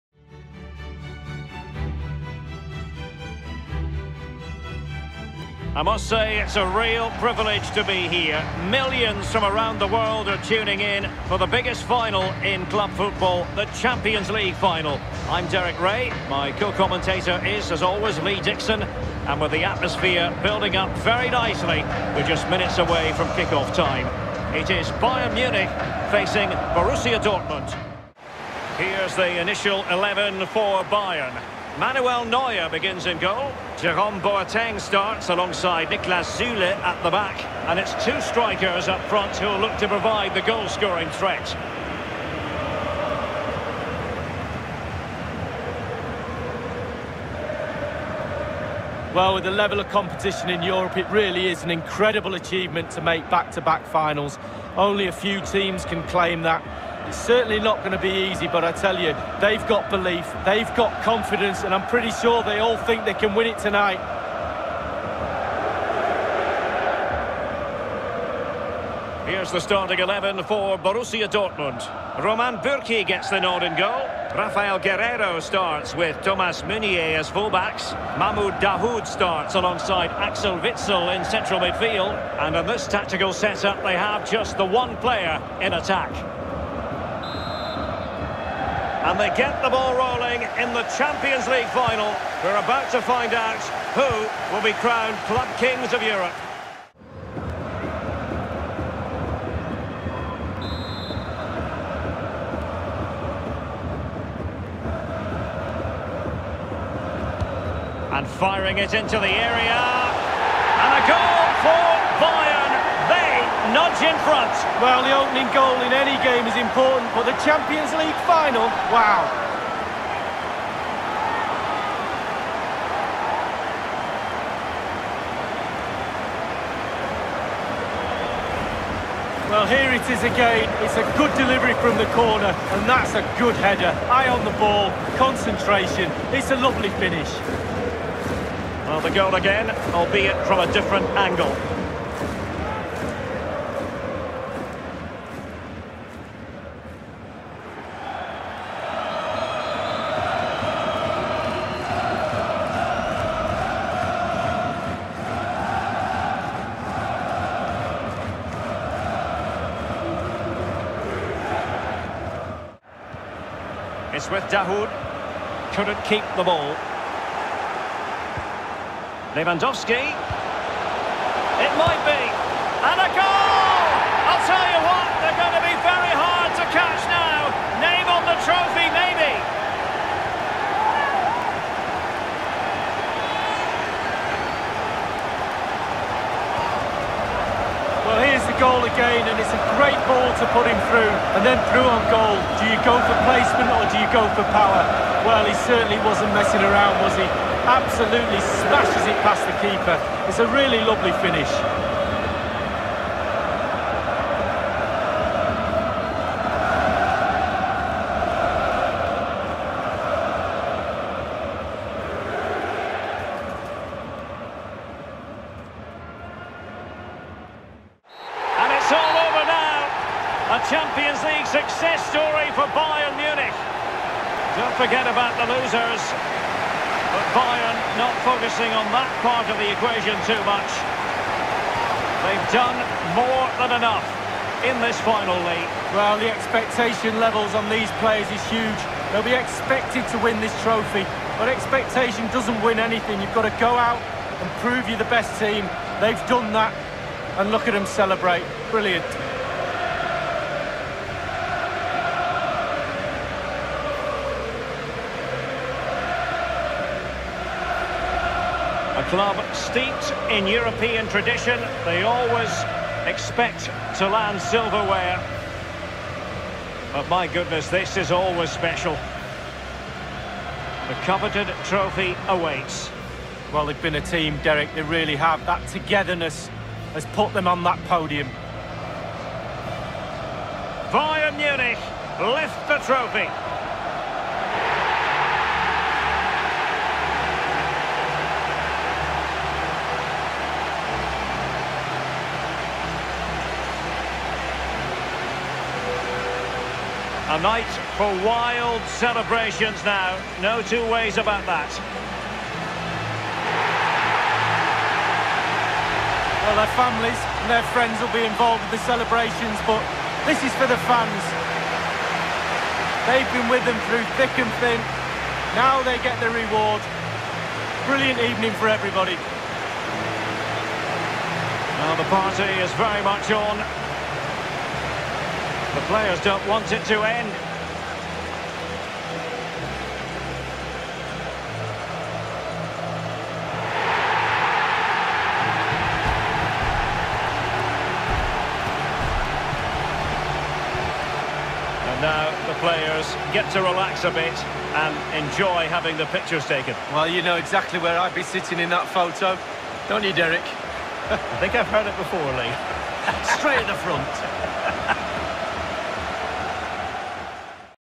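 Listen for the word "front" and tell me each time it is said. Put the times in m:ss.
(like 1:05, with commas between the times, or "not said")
0:39, 1:54, 5:53.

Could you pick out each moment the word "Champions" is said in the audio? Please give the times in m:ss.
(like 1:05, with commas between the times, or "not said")
0:13, 1:30, 1:57.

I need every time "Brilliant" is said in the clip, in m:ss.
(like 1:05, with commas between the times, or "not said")
4:08, 5:17.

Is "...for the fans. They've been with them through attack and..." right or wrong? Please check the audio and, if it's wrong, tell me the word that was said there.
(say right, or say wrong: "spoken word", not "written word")
wrong: "thick", not "attack".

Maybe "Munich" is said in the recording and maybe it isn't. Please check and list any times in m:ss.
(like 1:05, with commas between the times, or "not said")
0:25, 3:43, 4:41.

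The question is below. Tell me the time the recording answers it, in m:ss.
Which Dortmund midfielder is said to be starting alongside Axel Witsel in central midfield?
1:18.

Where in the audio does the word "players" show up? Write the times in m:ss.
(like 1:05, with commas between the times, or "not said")
1:24, 3:58, 5:25, 5:42.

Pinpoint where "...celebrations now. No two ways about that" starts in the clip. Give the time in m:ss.
4:58.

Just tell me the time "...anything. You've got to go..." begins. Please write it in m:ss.
4:02.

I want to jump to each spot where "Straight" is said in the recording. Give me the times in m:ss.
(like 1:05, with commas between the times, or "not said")
5:53.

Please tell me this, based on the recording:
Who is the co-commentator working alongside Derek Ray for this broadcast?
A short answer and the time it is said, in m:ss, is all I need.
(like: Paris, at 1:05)
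Lee Dixon, at 0:18.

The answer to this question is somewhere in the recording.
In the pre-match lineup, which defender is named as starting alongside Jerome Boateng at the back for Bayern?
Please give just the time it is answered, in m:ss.
0:35.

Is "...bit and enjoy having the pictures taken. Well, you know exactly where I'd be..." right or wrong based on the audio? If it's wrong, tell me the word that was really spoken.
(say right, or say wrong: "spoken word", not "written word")
right.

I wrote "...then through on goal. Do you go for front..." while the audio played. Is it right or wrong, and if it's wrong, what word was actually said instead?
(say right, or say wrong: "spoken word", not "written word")
wrong: "placement", not "front".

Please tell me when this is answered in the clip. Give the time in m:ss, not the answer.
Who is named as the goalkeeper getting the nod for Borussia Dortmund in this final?
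1:12.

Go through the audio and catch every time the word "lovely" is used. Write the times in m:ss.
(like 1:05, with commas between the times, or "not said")
2:16, 3:20.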